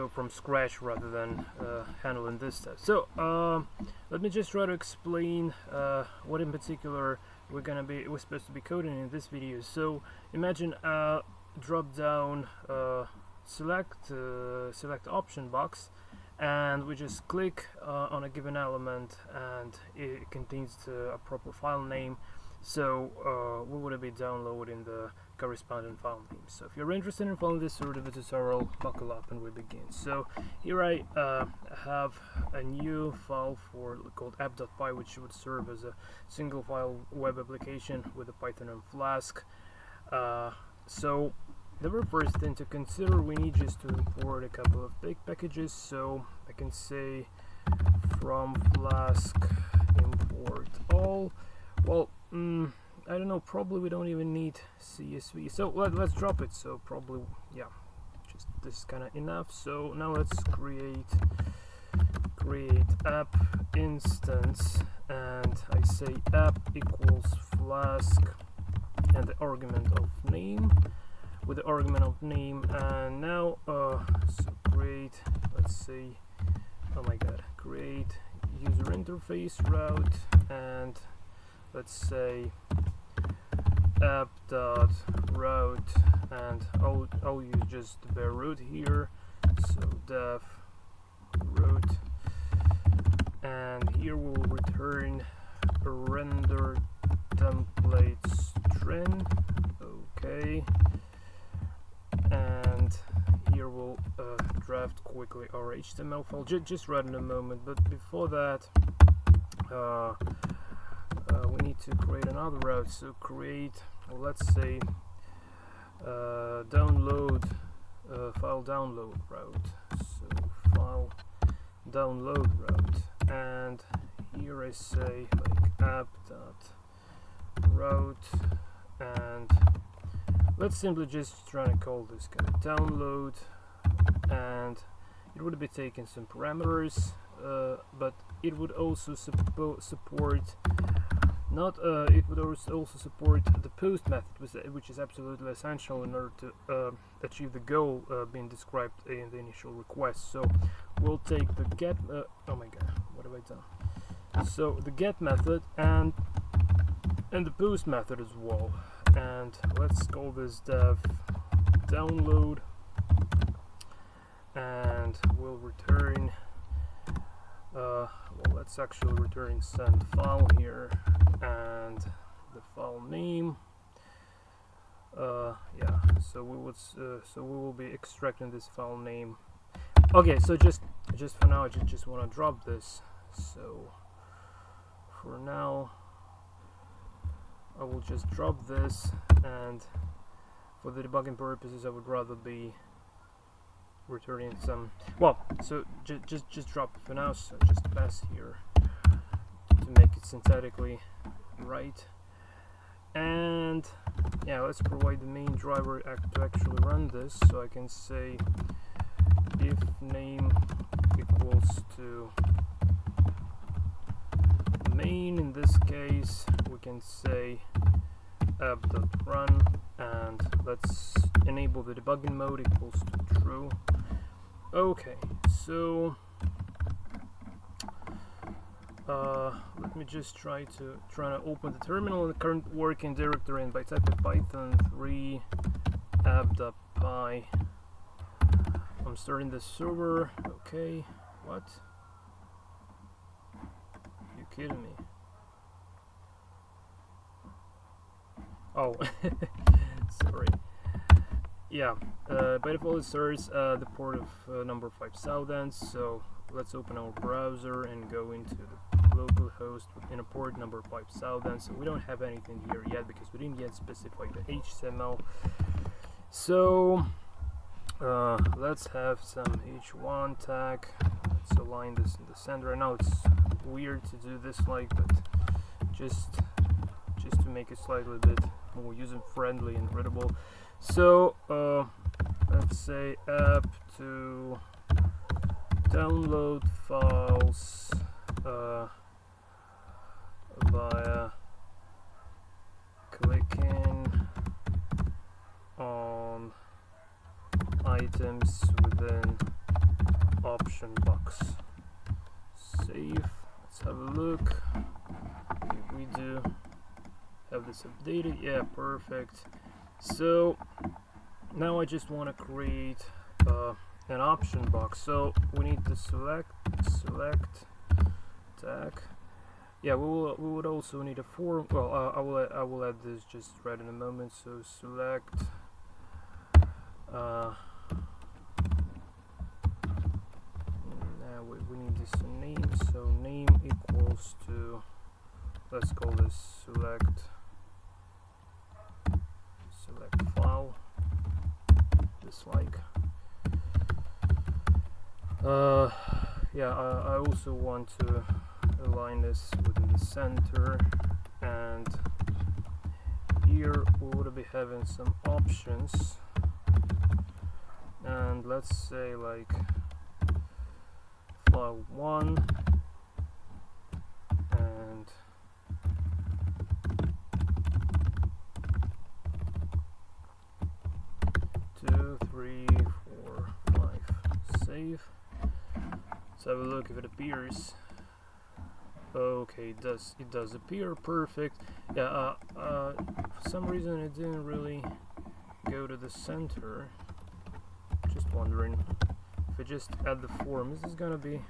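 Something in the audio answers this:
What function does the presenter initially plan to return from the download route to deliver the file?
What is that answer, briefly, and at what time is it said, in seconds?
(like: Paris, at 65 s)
send file, at 169 s.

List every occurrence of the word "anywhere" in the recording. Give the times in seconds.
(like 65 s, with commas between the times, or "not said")
not said.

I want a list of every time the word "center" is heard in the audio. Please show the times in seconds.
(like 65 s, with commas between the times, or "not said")
272 s, 349 s, 386 s.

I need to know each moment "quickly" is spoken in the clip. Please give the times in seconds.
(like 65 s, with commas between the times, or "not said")
105 s.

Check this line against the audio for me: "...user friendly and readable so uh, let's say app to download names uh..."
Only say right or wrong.
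wrong.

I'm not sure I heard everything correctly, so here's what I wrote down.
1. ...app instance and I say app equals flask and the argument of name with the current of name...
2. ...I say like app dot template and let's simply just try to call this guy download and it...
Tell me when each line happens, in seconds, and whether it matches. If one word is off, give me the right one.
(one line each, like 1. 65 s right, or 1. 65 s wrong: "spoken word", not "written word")
1. 63 s wrong: "argument", not "current"
2. 124 s wrong: "route", not "template".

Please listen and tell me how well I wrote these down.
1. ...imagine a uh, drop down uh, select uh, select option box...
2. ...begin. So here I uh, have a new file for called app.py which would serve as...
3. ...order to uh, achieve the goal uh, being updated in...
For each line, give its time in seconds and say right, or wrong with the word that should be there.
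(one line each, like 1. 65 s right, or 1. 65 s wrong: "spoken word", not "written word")
1. 10 s right
2. 29 s right
3. 146 s wrong: "described", not "updated".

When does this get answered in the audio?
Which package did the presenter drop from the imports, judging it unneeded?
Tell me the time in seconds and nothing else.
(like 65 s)
54 s.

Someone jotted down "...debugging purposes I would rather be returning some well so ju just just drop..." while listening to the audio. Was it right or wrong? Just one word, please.
right.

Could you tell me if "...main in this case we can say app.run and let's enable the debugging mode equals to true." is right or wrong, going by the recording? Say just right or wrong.
right.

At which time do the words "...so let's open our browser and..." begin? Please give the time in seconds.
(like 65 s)
255 s.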